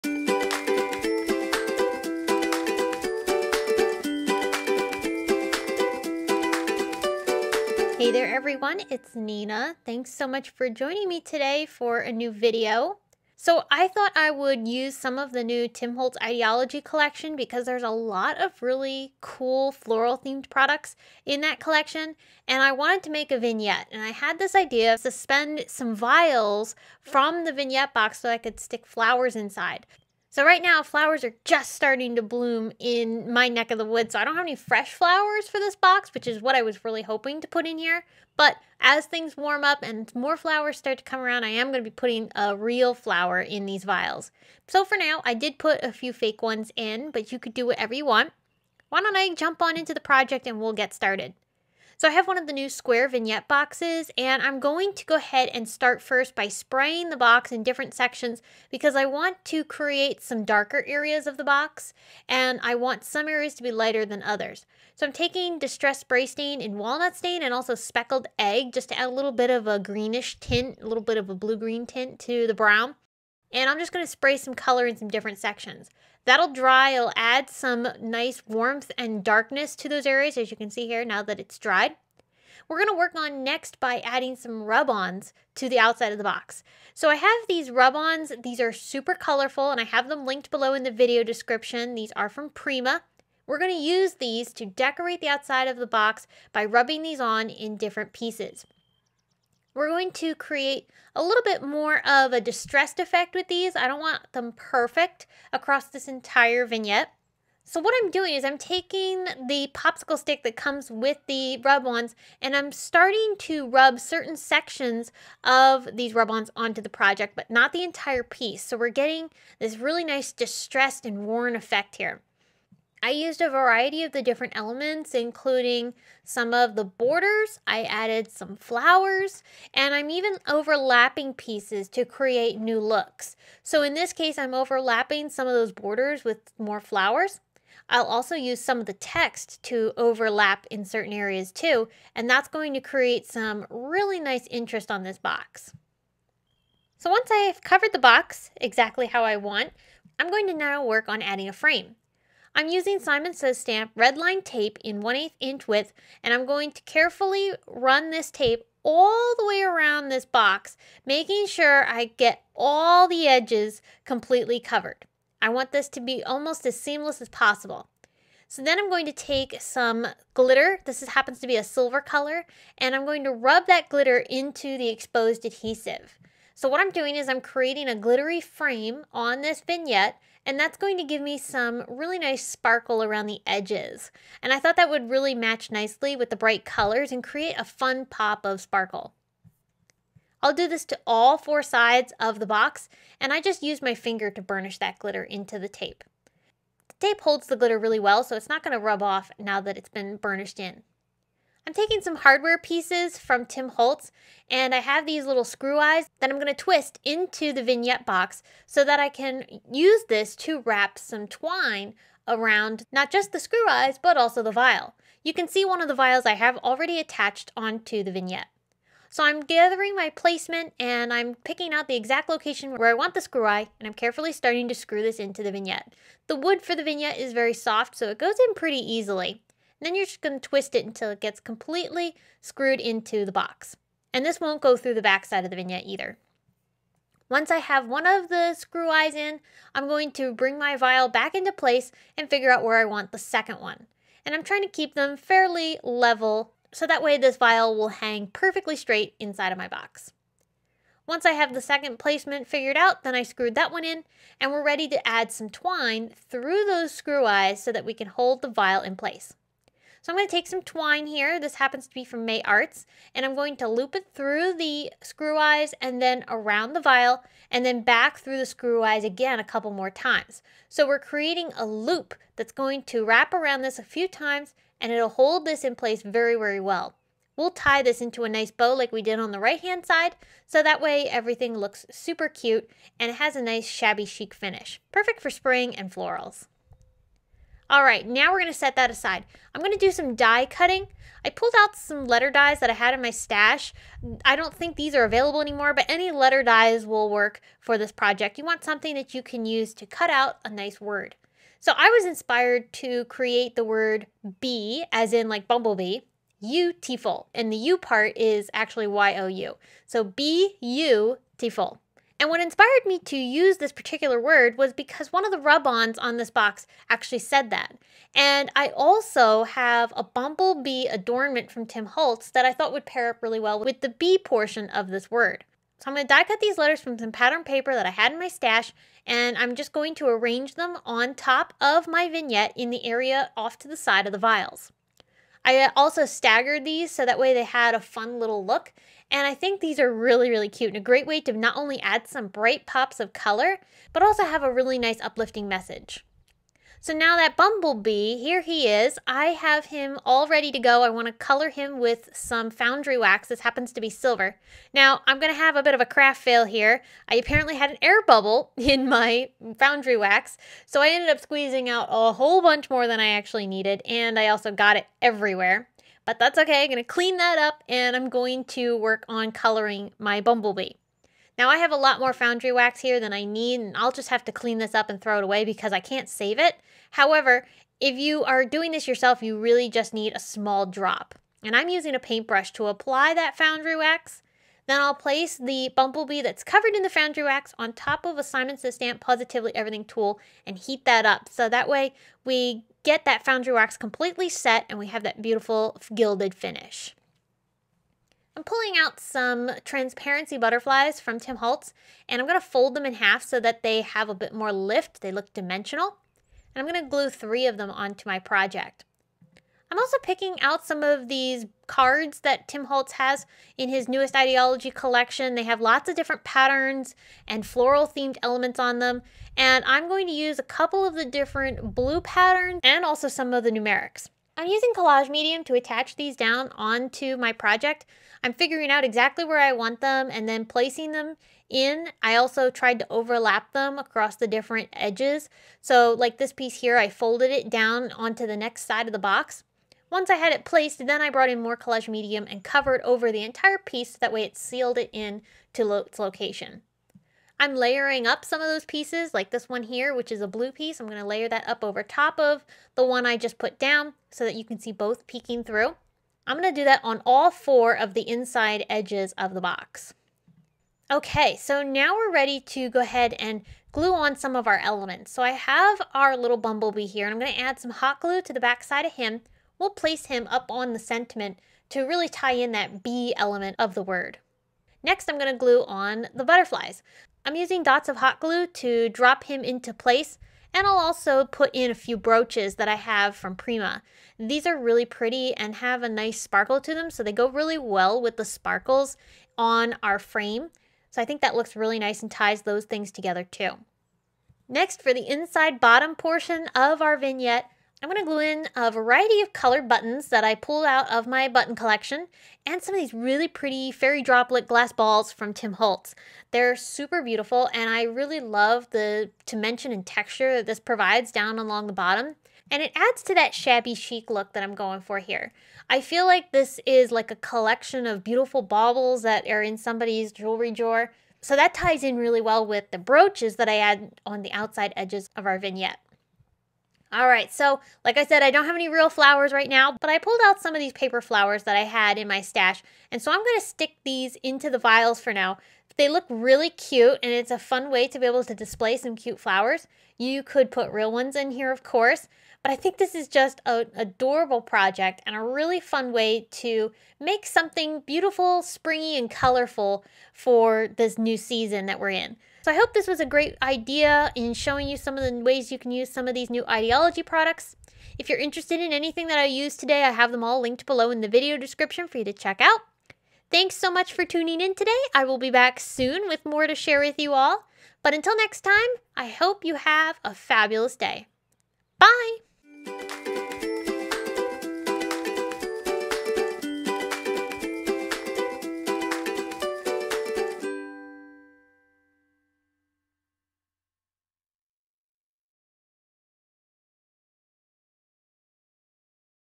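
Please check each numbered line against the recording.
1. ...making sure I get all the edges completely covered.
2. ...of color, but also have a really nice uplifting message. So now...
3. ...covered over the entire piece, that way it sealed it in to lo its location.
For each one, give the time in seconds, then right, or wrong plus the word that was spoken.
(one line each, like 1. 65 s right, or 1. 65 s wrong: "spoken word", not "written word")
1. 161 s right
2. 343 s right
3. 442 s right.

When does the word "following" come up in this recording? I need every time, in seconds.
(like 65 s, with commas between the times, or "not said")
not said.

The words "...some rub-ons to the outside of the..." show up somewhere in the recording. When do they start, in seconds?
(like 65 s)
84 s.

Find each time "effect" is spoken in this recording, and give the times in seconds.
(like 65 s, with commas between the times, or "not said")
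102 s, 121 s.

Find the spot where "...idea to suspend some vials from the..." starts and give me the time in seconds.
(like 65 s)
24 s.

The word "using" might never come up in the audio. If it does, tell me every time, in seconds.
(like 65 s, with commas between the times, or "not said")
152 s, 381 s, 424 s, 477 s.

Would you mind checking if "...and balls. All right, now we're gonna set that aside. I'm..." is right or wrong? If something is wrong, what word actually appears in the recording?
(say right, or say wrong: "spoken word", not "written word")
wrong: "florals", not "balls".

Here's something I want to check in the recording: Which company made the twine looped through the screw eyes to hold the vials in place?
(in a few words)
May Arts.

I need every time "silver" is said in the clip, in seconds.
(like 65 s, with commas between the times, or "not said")
171 s, 353 s.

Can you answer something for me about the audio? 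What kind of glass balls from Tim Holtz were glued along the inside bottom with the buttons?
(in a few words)
Fairy droplet glass balls.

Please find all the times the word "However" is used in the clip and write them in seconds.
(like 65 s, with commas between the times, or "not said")
376 s.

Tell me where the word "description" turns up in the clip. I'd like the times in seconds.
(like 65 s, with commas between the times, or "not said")
91 s, 561 s.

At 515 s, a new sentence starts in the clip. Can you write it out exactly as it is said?
I feel like this is like a collection of beautiful baubles that are in somebody's jewelry drawer.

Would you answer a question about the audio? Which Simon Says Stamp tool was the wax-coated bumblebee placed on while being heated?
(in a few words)
Positively Everything tool.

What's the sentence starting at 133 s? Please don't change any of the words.
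So in this case, I'm overlapping some of those borders with more flowers.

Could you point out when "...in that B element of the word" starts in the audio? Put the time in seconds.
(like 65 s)
472 s.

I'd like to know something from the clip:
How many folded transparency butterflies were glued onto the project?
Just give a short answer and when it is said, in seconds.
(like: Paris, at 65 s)
3, at 407 s.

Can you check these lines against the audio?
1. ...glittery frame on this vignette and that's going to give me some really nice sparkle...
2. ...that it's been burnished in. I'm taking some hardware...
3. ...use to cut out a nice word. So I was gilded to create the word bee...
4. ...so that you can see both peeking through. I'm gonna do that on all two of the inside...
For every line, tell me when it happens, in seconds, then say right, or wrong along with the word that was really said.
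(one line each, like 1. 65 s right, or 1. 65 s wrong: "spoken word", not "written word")
1. 177 s right
2. 199 s right
3. 299 s wrong: "inspired", not "gilded"
4. 454 s wrong: "four", not "two".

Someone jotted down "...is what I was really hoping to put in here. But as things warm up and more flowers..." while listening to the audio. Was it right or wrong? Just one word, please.
right.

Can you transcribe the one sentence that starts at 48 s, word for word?
Why don't I jump on into the project and we'll get started.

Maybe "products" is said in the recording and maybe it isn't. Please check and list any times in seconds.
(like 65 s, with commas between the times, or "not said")
20 s, 557 s.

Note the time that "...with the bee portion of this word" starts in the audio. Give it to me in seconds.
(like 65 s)
323 s.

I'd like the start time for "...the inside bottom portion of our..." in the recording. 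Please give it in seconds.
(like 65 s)
494 s.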